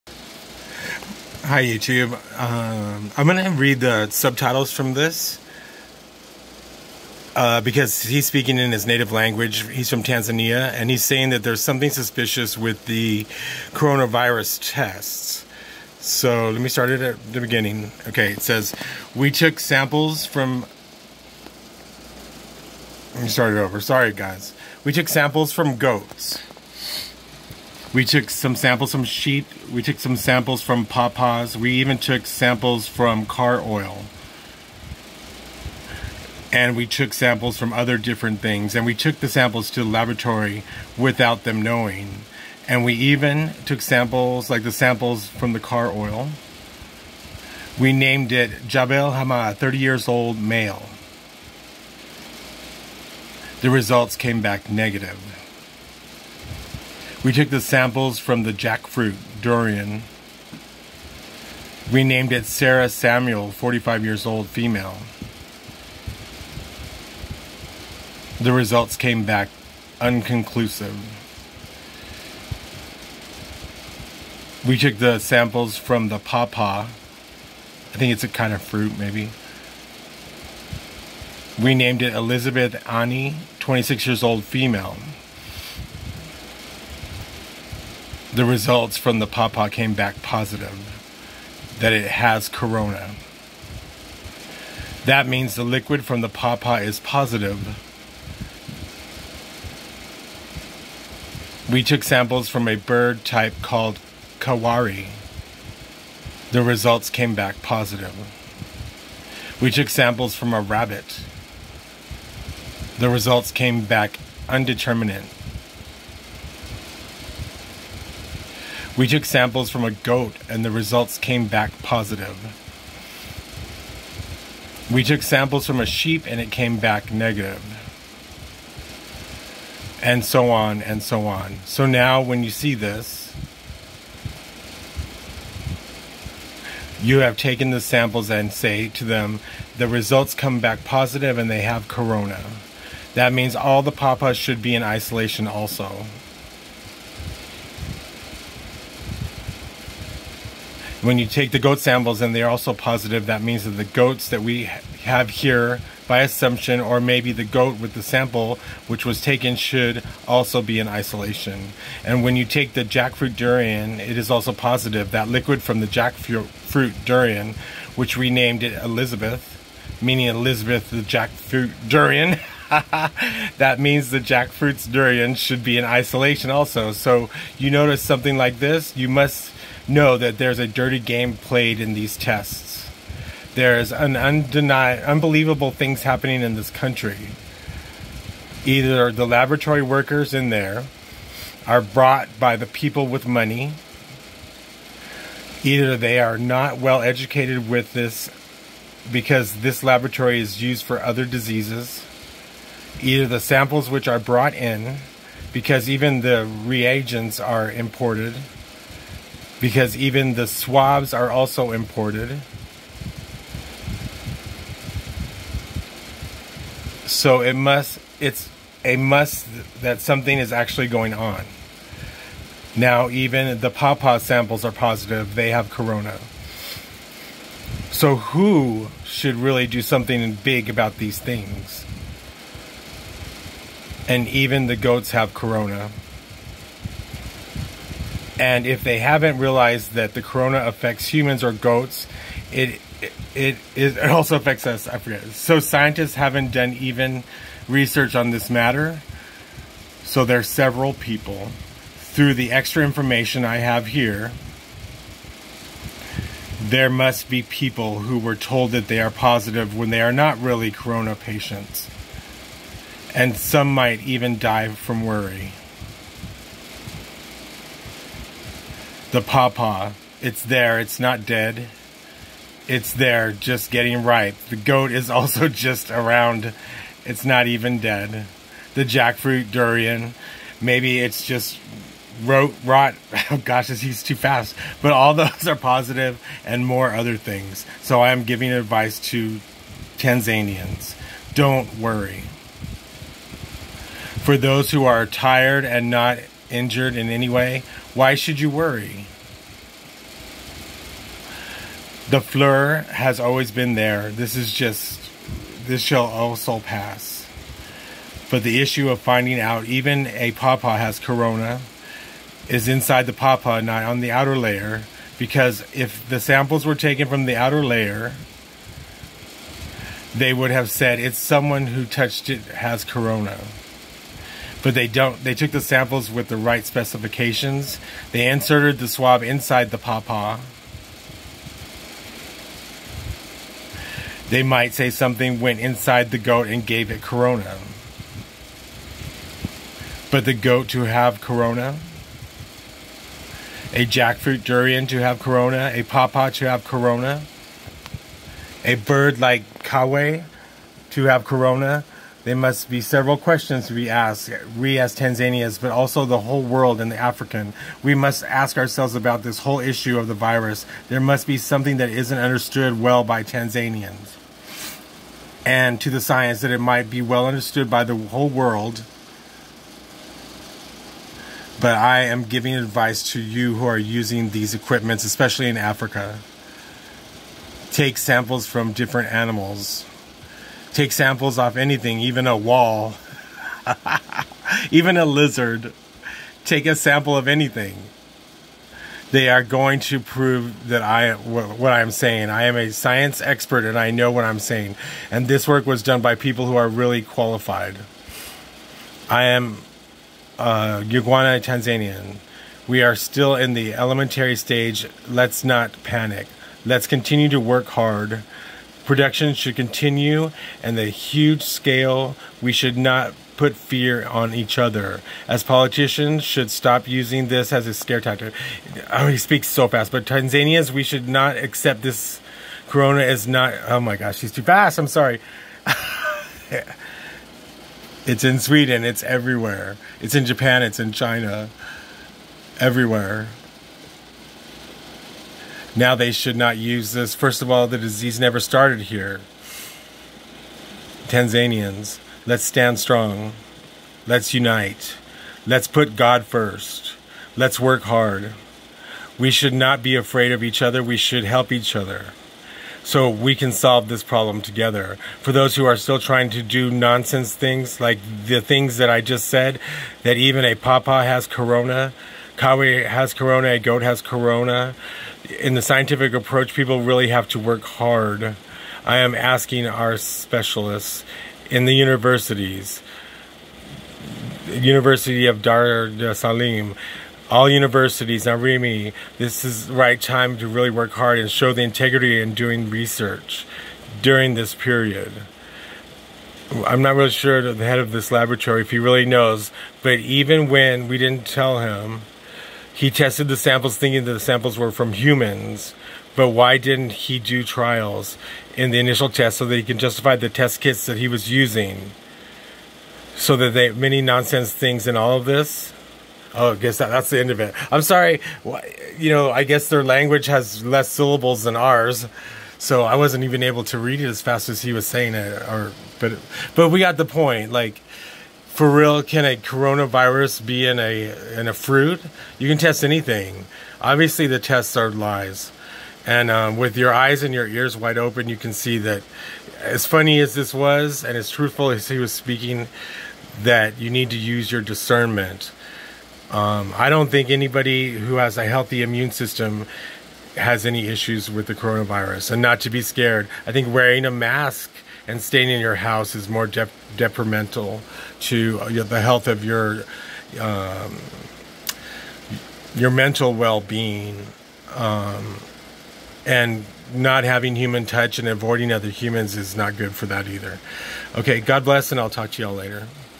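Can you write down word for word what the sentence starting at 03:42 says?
Now, even the pawpaw samples are positive, they have corona.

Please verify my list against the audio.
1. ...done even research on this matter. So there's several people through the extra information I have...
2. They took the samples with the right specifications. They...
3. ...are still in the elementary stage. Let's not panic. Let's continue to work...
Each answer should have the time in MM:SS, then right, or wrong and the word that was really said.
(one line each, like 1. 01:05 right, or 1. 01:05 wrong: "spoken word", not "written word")
1. 04:06 right
2. 05:25 right
3. 06:42 right.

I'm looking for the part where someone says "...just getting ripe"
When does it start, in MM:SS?
04:33.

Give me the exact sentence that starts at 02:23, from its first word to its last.
That means all the papas should be in isolation also.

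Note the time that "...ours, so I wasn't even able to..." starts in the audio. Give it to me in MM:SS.
08:31.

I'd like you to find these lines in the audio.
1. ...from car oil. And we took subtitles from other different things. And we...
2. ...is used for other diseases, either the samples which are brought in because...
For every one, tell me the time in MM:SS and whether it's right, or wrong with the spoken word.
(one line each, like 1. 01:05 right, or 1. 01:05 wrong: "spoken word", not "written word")
1. 00:32 wrong: "samples", not "subtitles"
2. 03:20 right.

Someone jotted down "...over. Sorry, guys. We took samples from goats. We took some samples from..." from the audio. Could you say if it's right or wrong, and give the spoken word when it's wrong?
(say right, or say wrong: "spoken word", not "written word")
right.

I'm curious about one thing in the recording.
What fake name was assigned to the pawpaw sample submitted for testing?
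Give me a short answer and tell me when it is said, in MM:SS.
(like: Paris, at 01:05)
Elizabeth Annie, at 01:22.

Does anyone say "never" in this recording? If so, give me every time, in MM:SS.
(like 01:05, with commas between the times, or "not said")
07:18.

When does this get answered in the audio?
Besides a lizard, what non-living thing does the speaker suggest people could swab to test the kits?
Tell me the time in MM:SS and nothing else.
06:22.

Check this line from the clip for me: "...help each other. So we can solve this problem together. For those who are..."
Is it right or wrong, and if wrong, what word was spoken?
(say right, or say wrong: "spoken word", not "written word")
right.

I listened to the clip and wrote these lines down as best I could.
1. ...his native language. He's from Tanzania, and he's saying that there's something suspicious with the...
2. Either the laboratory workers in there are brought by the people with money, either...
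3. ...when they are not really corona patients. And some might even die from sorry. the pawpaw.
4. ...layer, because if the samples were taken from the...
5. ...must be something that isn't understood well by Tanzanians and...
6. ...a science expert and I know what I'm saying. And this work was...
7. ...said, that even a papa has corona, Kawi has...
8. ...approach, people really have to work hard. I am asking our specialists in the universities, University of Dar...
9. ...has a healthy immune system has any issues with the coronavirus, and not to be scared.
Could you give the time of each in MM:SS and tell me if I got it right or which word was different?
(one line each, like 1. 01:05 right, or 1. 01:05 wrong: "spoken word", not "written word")
1. 00:08 right
2. 03:08 right
3. 04:19 wrong: "worry", not "sorry"
4. 05:14 right
5. 06:00 right
6. 06:32 right
7. 07:39 right
8. 07:46 right
9. 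08:58 right.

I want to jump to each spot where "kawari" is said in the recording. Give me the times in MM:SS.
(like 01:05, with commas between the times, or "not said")
01:44.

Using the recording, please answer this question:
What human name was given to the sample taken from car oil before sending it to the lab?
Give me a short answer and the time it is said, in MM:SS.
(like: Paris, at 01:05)
Jabel Hamad, at 00:48.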